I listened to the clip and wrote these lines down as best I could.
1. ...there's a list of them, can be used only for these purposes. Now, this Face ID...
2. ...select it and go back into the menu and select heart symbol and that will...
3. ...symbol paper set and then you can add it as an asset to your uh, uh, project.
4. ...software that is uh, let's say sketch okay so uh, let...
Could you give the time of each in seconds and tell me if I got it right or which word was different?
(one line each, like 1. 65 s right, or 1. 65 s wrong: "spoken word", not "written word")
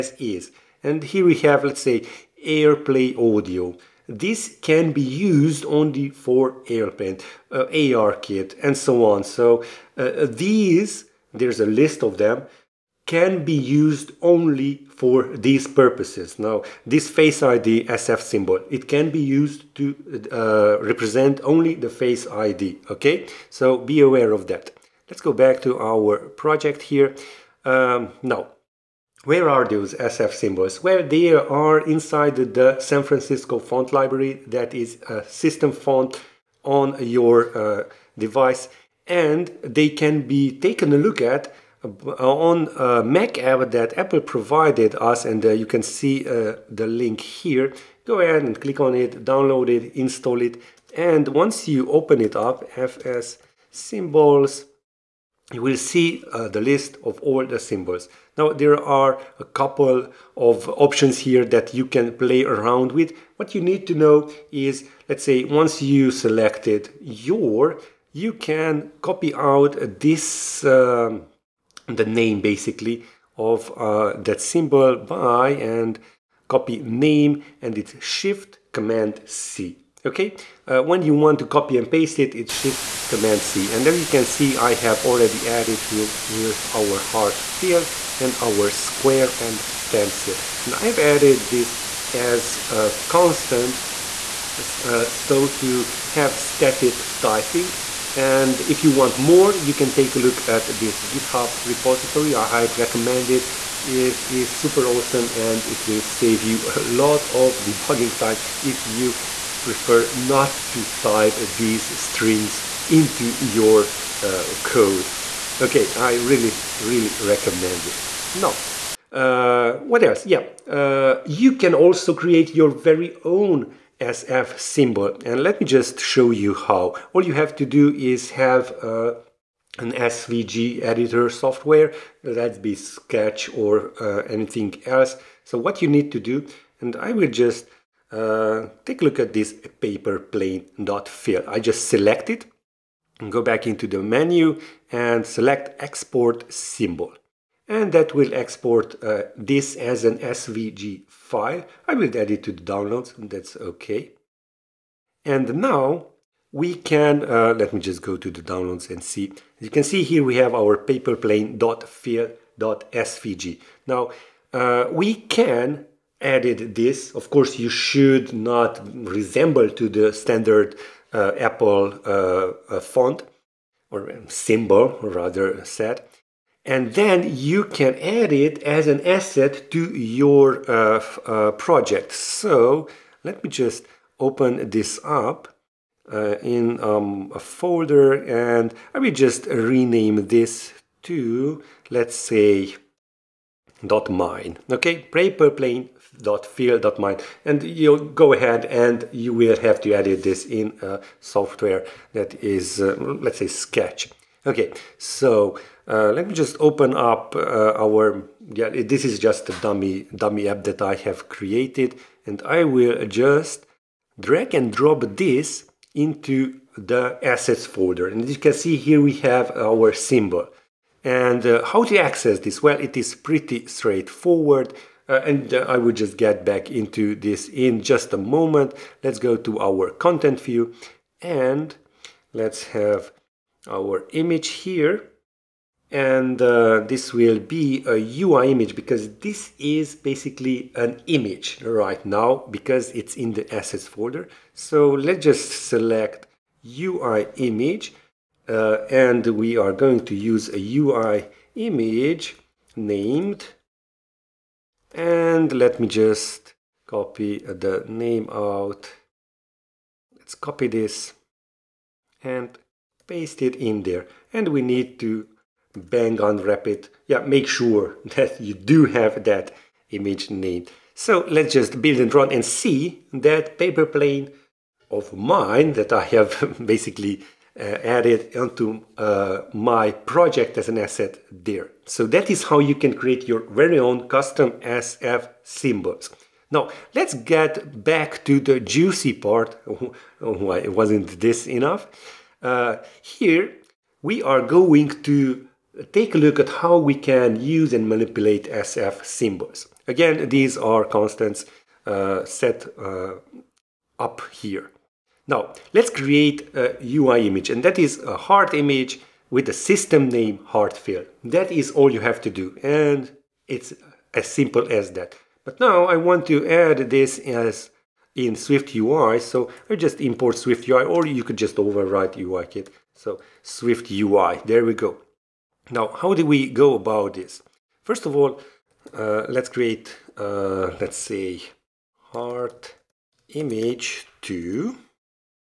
1. 11 s right
2. 141 s wrong: "export", not "heart"
3. 174 s wrong: "rather", not "paper"
4. 201 s right.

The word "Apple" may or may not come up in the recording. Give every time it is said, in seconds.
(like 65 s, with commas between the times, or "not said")
43 s, 171 s.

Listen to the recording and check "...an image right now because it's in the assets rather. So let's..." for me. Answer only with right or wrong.
wrong.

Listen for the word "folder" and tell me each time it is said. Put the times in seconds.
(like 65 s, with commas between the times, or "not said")
187 s, 217 s, 243 s.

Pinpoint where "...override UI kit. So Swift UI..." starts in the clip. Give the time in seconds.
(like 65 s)
321 s.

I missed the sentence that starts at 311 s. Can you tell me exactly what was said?
That is all you have to do, and it's as simple as that.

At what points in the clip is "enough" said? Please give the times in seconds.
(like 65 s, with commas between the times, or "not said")
291 s.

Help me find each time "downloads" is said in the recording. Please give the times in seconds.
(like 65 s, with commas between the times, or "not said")
49 s, 152 s, 158 s.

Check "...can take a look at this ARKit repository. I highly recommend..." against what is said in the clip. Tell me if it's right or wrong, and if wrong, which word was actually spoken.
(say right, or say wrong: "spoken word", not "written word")
wrong: "GitHub", not "ARKit".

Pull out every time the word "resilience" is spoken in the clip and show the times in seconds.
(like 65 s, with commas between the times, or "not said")
not said.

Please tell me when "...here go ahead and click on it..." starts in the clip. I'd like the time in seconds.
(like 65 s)
47 s.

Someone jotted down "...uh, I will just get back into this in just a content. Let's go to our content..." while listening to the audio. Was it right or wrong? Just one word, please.
wrong.